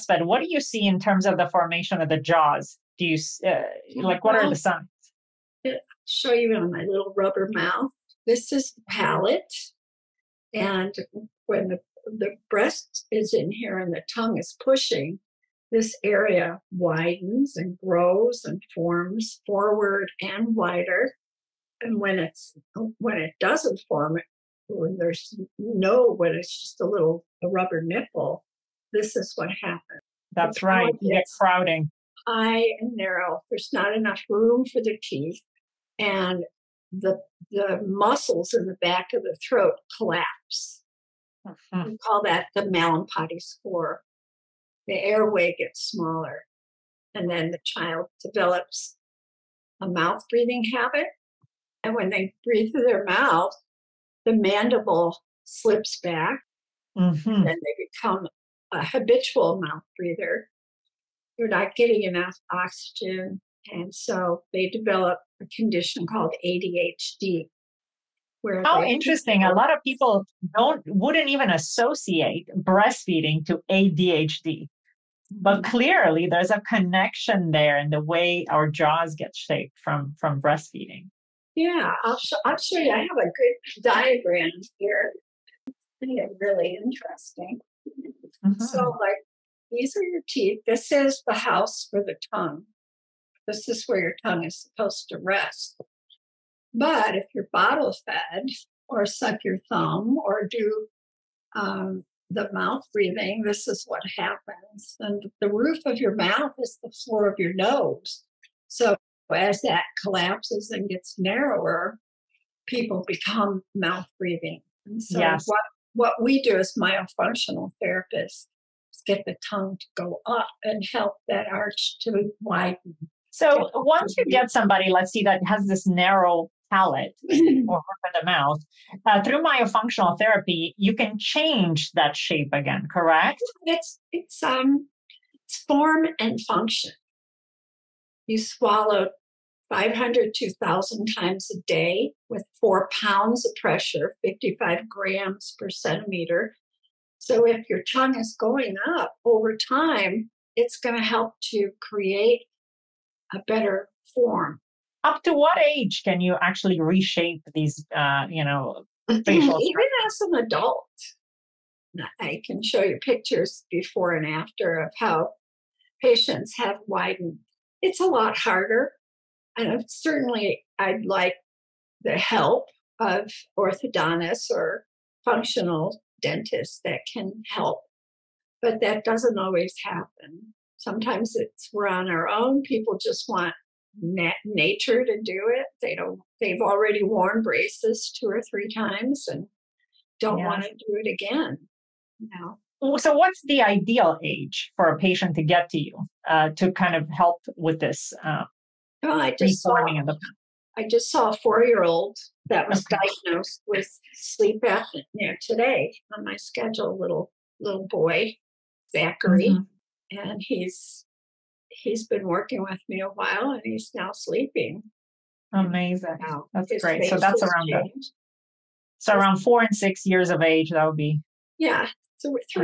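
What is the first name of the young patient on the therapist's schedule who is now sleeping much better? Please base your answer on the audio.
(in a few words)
Zachary.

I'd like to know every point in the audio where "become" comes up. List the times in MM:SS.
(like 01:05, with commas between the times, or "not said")
00:57, 01:53.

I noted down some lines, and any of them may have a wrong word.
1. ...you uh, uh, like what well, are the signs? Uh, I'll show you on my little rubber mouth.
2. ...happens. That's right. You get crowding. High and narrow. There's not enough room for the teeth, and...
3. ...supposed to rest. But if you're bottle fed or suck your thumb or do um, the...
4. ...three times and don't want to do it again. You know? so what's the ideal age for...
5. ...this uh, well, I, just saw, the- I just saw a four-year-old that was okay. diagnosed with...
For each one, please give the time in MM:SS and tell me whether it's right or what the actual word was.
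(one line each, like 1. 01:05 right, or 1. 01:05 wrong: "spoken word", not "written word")
1. 00:03 right
2. 00:29 right
3. 01:34 right
4. 03:08 right
5. 03:17 right.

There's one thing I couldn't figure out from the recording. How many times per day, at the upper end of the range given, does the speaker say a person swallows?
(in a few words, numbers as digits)
1,000.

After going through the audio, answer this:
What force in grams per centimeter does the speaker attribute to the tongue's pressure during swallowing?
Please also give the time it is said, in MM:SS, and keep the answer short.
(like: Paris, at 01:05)
55 grams per centimeter, at 02:24.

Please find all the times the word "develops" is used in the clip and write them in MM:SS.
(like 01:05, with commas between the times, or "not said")
00:48, 01:04.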